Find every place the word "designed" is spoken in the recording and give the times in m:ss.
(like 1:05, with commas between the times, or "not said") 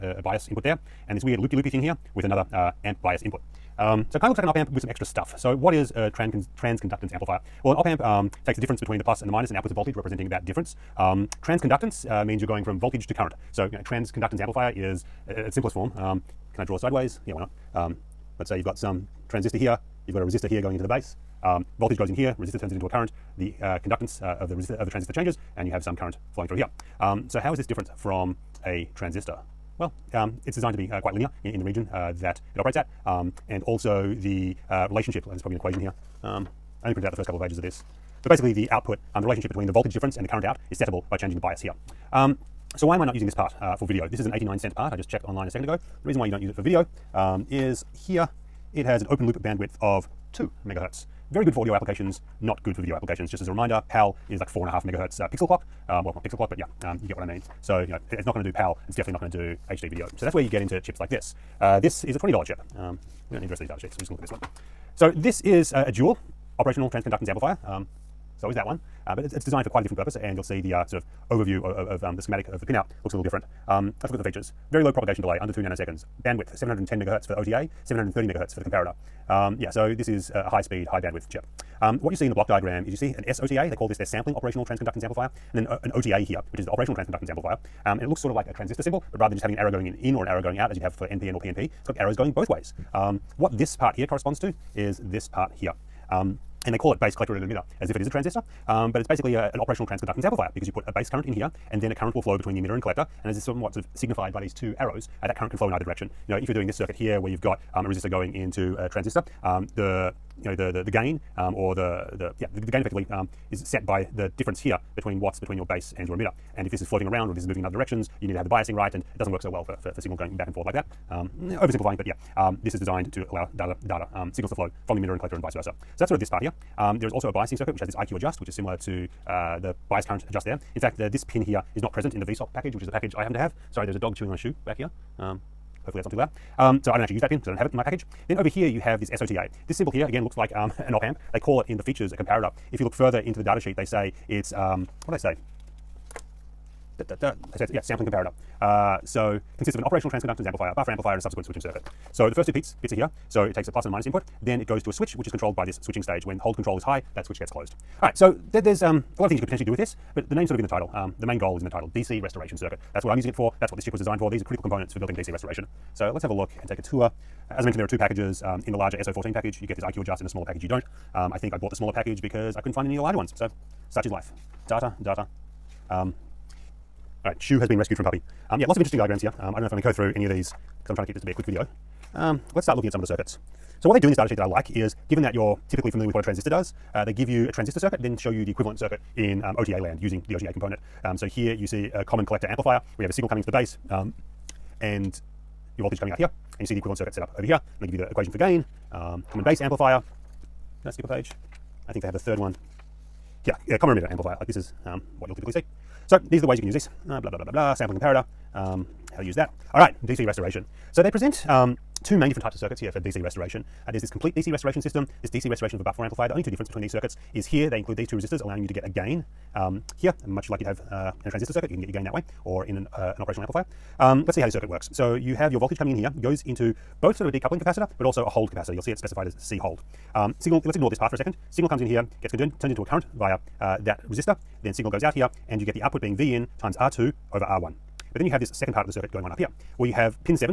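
0:30, 1:09, 2:02, 2:43.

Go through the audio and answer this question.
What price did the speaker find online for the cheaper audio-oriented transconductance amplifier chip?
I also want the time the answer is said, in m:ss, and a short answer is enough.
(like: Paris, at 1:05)
89 cents, at 0:44.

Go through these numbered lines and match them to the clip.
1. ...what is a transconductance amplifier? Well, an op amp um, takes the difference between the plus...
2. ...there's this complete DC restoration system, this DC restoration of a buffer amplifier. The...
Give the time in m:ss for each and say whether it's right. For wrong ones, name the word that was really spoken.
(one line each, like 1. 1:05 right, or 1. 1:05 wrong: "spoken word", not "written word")
1. 0:05 right
2. 3:33 right.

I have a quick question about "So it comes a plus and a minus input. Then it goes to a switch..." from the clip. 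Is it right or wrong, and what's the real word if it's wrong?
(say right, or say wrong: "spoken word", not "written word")
wrong: "takes", not "comes".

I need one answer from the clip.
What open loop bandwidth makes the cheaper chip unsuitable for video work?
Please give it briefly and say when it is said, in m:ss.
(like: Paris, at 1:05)
2 megahertz, at 0:50.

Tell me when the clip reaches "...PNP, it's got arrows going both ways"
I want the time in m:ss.
1:31.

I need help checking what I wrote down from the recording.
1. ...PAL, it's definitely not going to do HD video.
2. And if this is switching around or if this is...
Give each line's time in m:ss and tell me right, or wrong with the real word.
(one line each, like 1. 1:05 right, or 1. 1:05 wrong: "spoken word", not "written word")
1. 0:58 right
2. 1:56 wrong: "floating", not "switching".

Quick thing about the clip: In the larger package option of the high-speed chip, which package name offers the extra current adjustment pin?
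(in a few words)
SO14.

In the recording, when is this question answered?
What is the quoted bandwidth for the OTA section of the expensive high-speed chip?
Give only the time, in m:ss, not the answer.
1:16.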